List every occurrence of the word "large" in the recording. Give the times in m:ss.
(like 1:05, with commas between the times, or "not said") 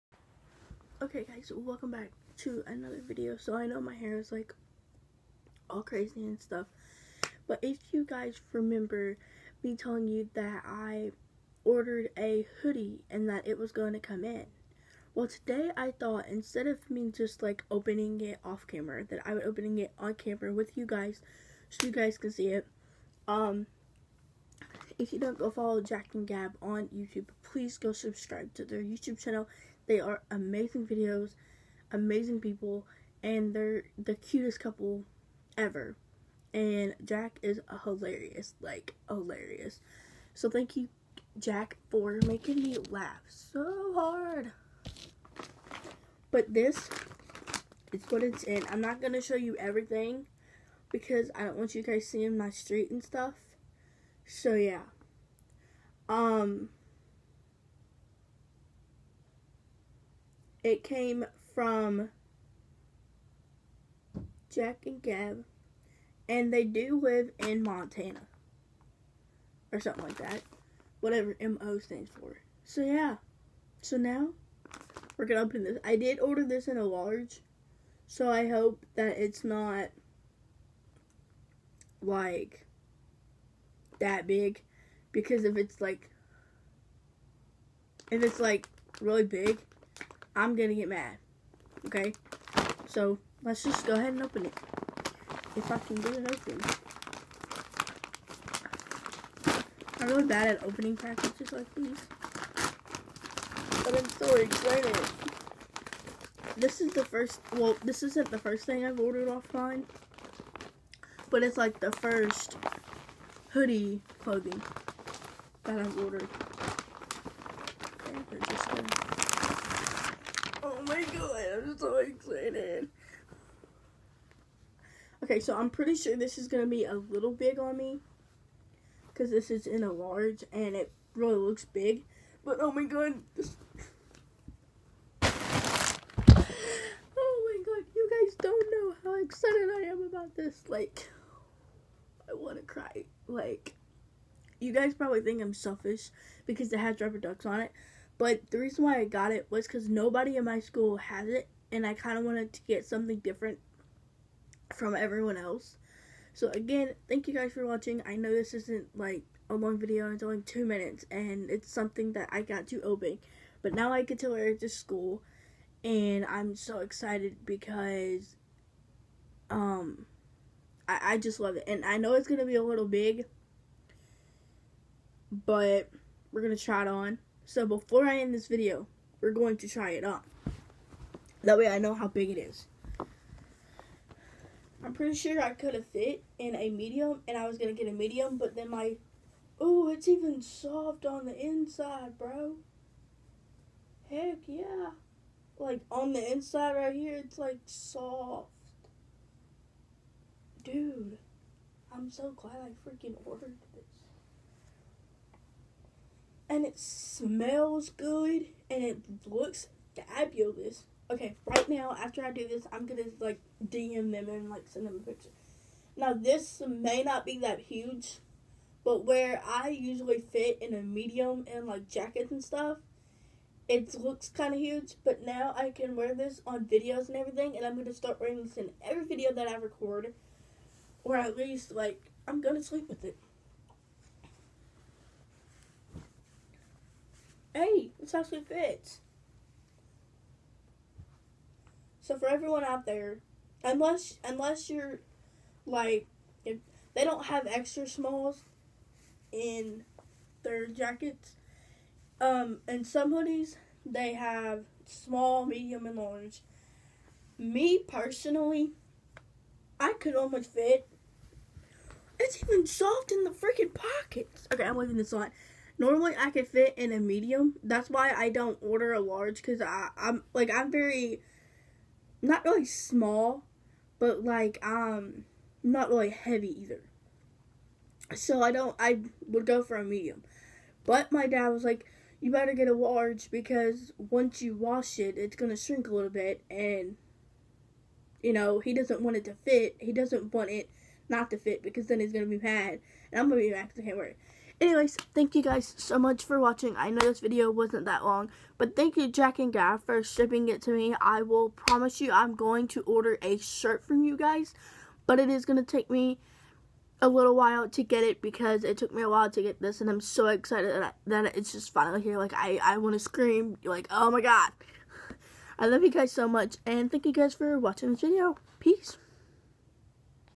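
1:16, 2:09, 4:15, 4:28, 4:42.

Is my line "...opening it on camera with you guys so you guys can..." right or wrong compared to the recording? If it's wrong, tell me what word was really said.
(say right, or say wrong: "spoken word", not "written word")
right.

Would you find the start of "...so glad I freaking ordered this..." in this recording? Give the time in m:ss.
3:22.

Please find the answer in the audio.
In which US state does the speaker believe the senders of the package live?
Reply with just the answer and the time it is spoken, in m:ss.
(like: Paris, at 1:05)
Montana, at 1:07.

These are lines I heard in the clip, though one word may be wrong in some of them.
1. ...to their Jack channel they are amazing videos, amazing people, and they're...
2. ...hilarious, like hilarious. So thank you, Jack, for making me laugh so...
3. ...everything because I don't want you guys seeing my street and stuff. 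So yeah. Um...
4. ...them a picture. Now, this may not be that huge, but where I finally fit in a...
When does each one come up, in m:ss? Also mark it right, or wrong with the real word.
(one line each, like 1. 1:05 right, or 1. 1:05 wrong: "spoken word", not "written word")
1. 0:28 wrong: "YouTube", not "Jack"
2. 0:37 right
3. 0:49 right
4. 3:34 wrong: "usually", not "finally".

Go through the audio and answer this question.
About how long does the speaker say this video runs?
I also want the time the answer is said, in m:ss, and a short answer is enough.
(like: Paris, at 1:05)
2 minutes, at 2:40.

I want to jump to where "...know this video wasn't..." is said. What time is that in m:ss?
4:56.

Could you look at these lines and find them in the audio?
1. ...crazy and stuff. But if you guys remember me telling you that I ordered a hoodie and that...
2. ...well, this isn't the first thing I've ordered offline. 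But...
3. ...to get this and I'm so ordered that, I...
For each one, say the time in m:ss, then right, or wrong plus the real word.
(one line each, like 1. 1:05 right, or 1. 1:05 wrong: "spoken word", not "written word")
1. 0:05 right
2. 1:47 right
3. 5:09 wrong: "excited", not "ordered".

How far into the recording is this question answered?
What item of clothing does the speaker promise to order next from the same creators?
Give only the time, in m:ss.
5:03.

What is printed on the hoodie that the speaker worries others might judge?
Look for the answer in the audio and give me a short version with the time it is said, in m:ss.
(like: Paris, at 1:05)
Rubber ducks, at 2:26.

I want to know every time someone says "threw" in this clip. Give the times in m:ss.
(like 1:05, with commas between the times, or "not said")
not said.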